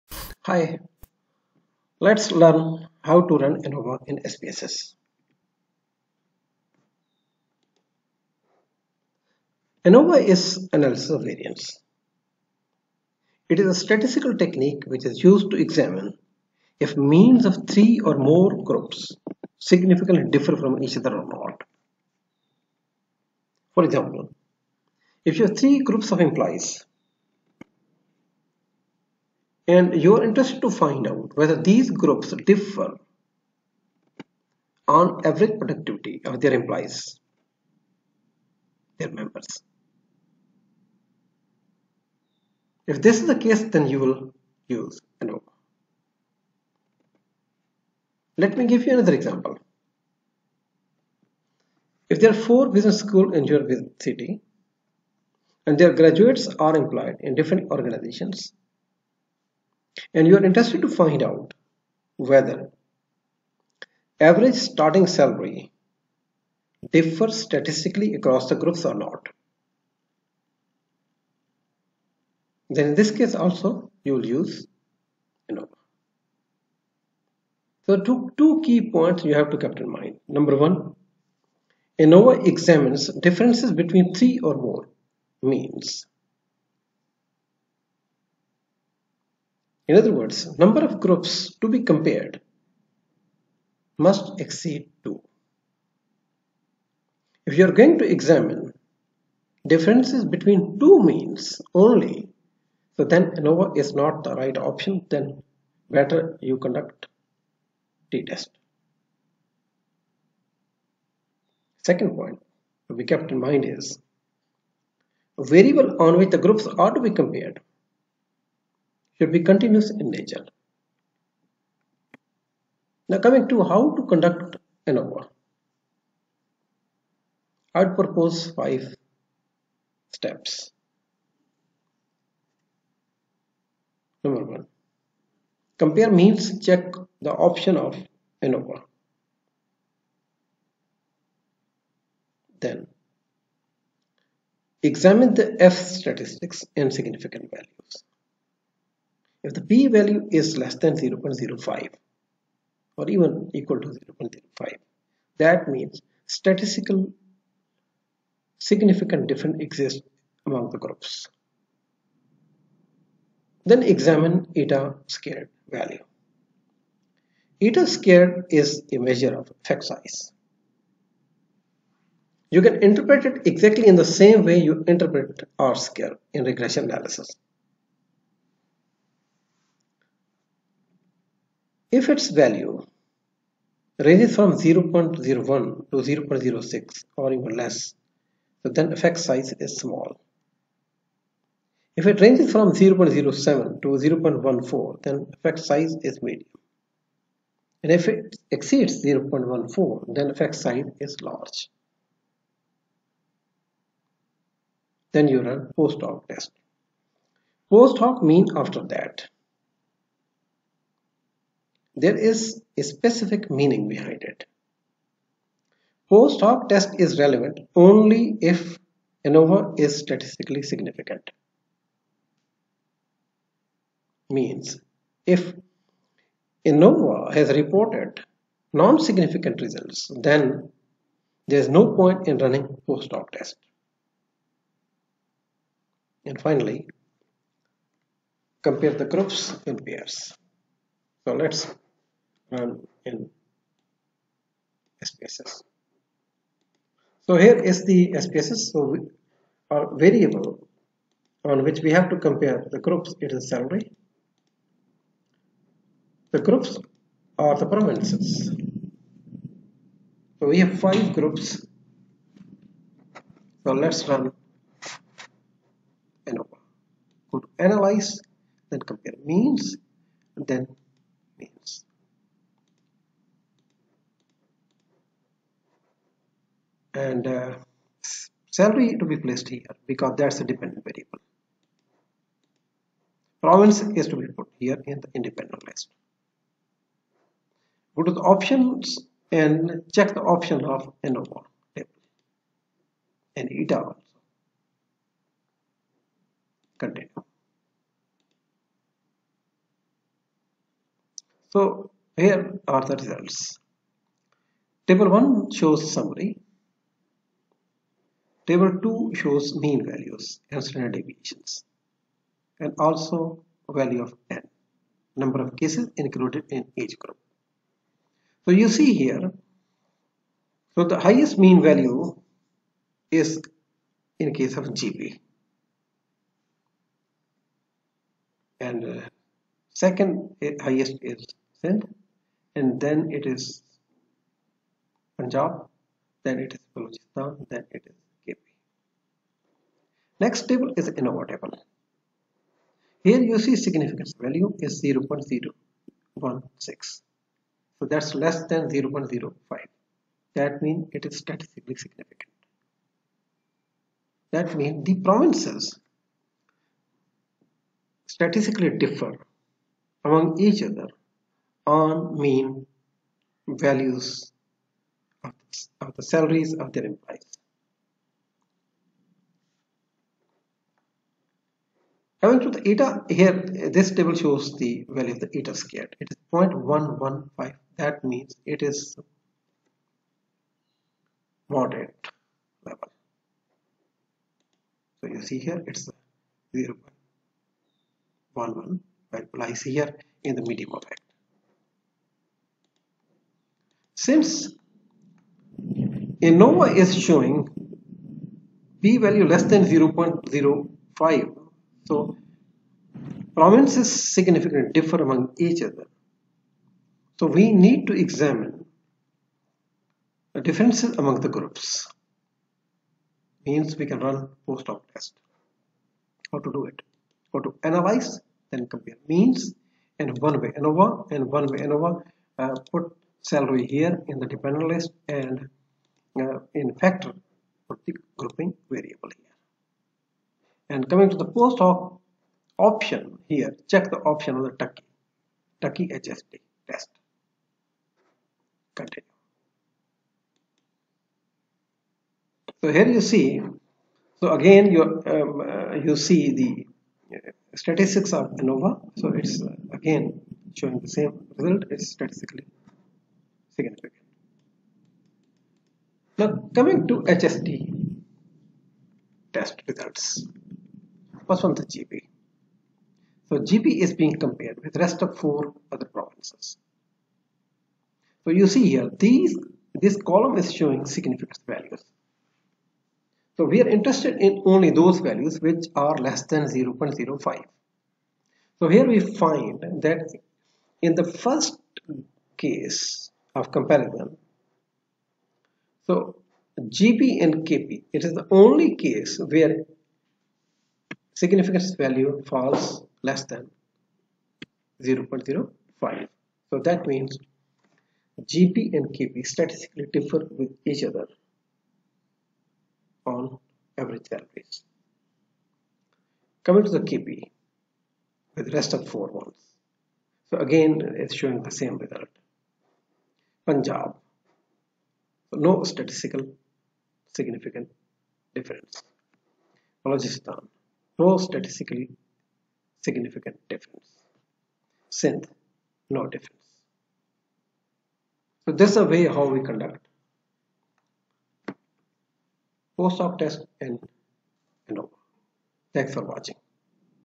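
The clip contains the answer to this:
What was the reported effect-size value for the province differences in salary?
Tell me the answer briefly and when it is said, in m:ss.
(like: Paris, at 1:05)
0.115, at 6:16.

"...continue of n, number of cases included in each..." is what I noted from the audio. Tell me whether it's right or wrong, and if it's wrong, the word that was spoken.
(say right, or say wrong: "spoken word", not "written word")
wrong: "value", not "continue".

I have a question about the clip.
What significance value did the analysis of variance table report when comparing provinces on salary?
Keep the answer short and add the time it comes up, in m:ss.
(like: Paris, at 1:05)
0.016, at 5:44.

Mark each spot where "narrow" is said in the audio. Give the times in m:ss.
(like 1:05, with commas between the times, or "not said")
not said.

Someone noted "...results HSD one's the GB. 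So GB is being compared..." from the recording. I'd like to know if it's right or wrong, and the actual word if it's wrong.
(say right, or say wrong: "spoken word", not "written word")
wrong: "First", not "HSD".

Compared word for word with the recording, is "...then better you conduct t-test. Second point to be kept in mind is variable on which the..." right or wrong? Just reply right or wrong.
right.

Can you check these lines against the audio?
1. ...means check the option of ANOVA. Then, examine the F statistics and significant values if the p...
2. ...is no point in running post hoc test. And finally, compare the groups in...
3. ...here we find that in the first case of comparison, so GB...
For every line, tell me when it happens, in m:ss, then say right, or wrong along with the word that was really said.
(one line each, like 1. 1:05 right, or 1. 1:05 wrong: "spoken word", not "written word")
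1. 2:16 right
2. 3:51 right
3. 7:58 right.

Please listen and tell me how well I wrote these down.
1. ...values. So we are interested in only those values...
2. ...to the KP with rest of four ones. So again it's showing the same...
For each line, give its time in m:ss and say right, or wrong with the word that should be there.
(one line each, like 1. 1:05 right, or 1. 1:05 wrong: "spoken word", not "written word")
1. 7:51 right
2. 8:26 right.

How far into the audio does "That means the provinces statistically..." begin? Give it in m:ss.
5:54.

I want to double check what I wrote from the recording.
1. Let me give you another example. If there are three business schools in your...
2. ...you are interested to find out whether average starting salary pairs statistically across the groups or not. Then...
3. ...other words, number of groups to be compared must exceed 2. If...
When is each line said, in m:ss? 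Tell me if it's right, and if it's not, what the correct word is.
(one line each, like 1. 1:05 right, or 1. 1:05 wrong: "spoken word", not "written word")
1. 0:48 wrong: "four", not "three"
2. 1:00 wrong: "differs", not "pairs"
3. 1:29 right.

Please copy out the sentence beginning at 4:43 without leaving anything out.
Province is to be put here in the independent list.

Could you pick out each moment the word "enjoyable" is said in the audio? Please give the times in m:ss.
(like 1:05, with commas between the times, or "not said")
not said.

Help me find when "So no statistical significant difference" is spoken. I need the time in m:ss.
8:35.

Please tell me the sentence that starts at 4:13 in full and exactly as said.
It is salary, the groups are the provinces.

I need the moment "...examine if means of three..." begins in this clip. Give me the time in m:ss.
0:15.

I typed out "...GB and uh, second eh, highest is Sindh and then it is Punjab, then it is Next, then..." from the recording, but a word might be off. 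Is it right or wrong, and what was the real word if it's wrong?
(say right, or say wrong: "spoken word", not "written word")
wrong: "Balochistan", not "Next".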